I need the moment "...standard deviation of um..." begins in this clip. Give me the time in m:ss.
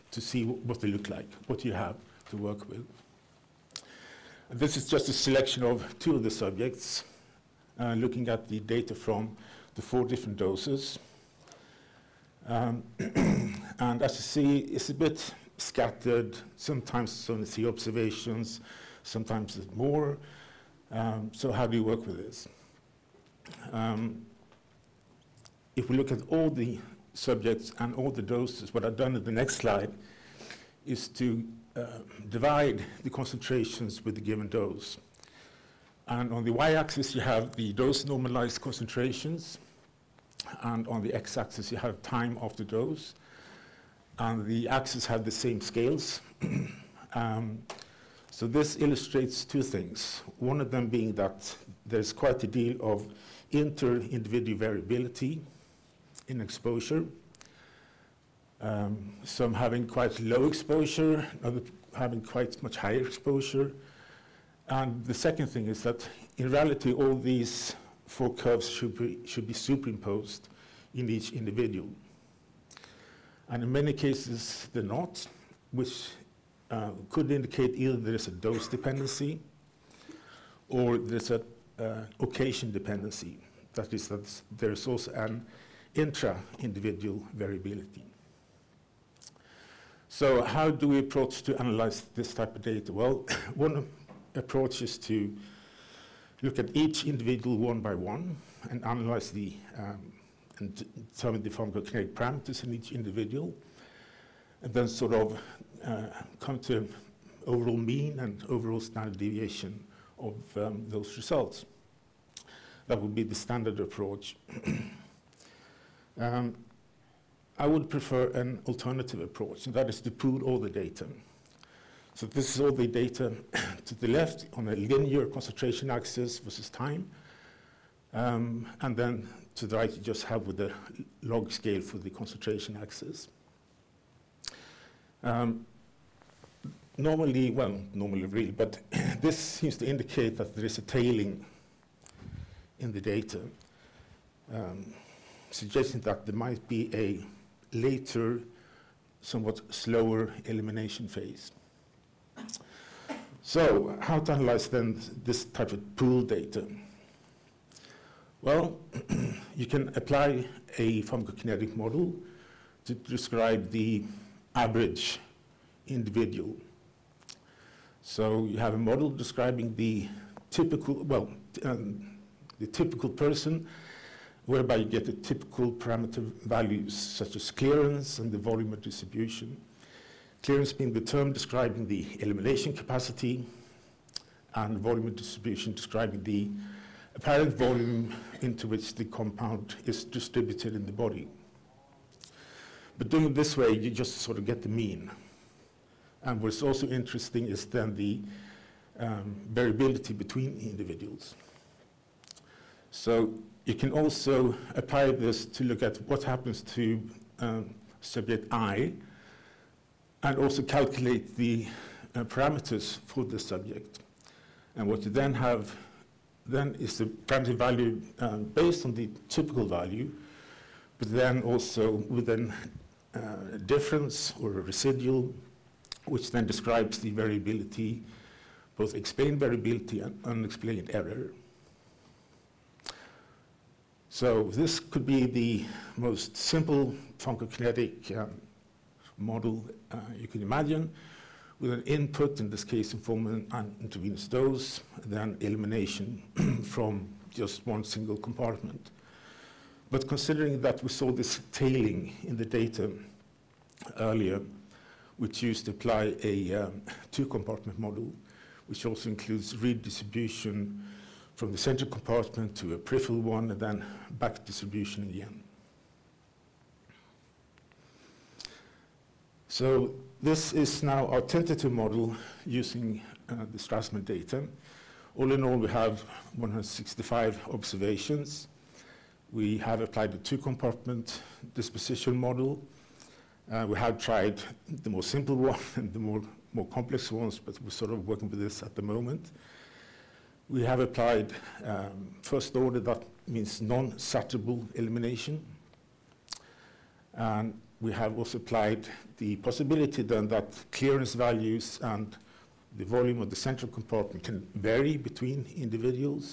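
1:48.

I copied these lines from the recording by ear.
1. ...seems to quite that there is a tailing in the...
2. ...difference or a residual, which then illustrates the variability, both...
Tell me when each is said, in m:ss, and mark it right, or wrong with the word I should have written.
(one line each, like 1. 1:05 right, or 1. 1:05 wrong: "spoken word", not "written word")
1. 2:19 wrong: "indicate", not "quite"
2. 3:43 wrong: "describes", not "illustrates".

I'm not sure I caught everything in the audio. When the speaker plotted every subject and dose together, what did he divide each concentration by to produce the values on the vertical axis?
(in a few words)
The given dose.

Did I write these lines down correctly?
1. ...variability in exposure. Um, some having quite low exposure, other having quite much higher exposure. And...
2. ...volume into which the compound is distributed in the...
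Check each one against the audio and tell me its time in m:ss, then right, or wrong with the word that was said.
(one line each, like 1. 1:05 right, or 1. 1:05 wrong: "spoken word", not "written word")
1. 0:54 right
2. 3:07 right.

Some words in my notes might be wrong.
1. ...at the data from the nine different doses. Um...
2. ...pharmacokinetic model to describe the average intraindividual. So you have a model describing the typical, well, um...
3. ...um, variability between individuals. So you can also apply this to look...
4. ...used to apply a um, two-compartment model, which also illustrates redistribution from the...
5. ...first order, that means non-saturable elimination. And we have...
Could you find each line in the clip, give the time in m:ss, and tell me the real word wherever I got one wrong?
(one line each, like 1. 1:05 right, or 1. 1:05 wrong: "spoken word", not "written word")
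1. 0:08 wrong: "four", not "nine"
2. 2:41 wrong: "individual", not "intraindividual"
3. 3:19 right
4. 4:15 wrong: "includes", not "illustrates"
5. 4:52 right.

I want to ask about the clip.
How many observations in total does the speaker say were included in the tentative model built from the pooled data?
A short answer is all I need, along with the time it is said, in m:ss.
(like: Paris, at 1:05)
165, at 4:36.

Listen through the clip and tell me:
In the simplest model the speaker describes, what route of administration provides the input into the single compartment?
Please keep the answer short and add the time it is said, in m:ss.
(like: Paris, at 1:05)
Intravenous dose, at 4:03.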